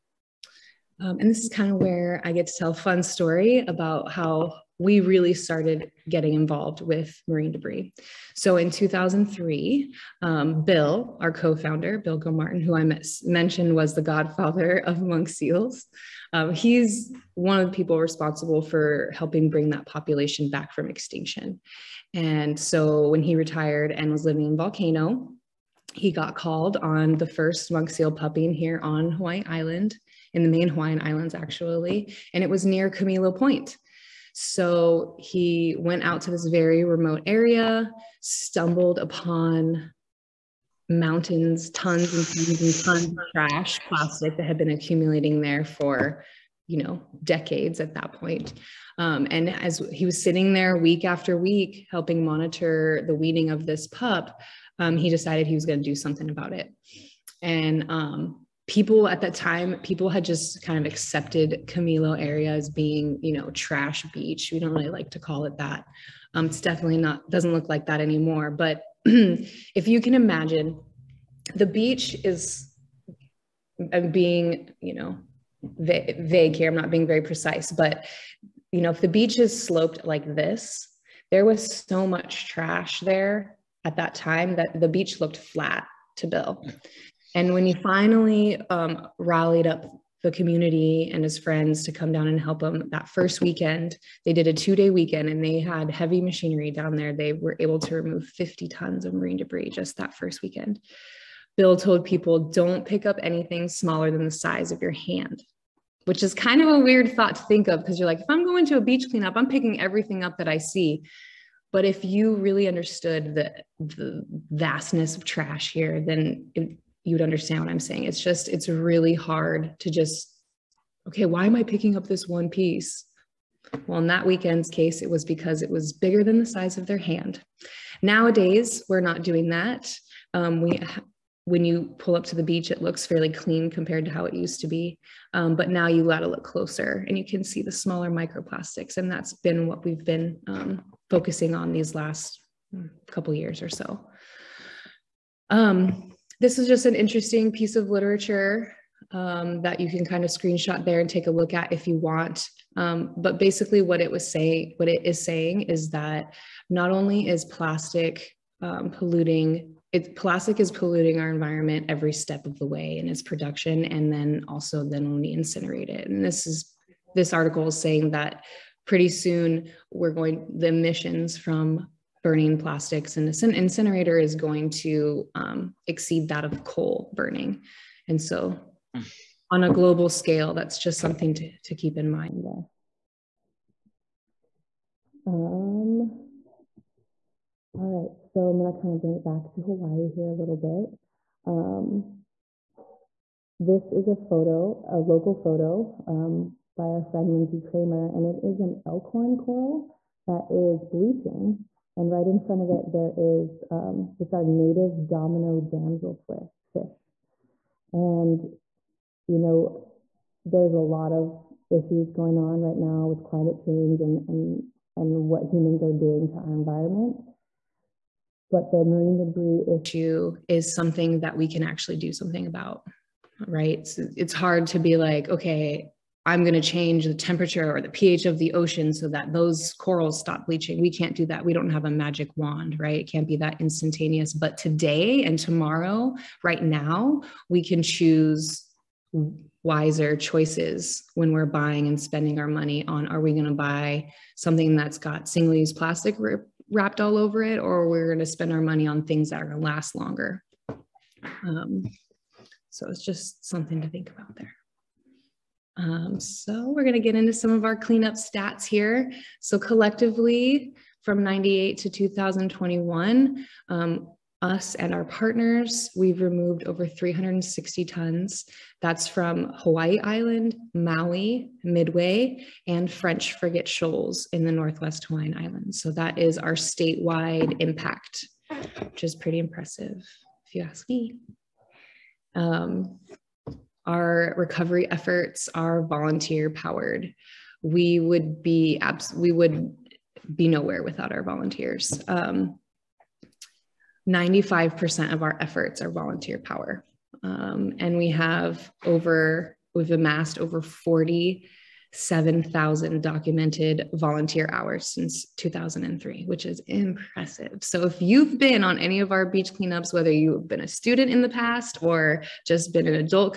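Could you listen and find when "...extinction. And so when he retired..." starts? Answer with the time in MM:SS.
00:20.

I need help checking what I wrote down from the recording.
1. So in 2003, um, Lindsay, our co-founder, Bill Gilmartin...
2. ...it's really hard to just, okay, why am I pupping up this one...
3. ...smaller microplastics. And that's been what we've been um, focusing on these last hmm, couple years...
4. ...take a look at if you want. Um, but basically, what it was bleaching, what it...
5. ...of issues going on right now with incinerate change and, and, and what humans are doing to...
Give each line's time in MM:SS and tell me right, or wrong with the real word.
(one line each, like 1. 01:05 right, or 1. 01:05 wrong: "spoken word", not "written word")
1. 00:08 wrong: "Bill", not "Lindsay"
2. 01:58 wrong: "picking", not "pupping"
3. 02:17 right
4. 02:31 wrong: "saying", not "bleaching"
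5. 03:31 wrong: "climate", not "incinerate".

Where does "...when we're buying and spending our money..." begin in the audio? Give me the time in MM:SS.
04:01.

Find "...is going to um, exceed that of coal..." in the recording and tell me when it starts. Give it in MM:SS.
02:54.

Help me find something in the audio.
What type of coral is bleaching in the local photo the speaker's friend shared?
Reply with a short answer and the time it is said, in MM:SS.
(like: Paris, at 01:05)
elkhorn coral, at 03:18.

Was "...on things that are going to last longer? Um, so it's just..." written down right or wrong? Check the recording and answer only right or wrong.
right.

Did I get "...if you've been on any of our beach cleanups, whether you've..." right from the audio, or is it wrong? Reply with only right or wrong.
right.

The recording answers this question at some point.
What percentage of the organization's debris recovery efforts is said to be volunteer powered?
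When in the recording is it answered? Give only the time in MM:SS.
04:52.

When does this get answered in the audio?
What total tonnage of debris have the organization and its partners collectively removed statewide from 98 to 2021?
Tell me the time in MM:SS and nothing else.
04:26.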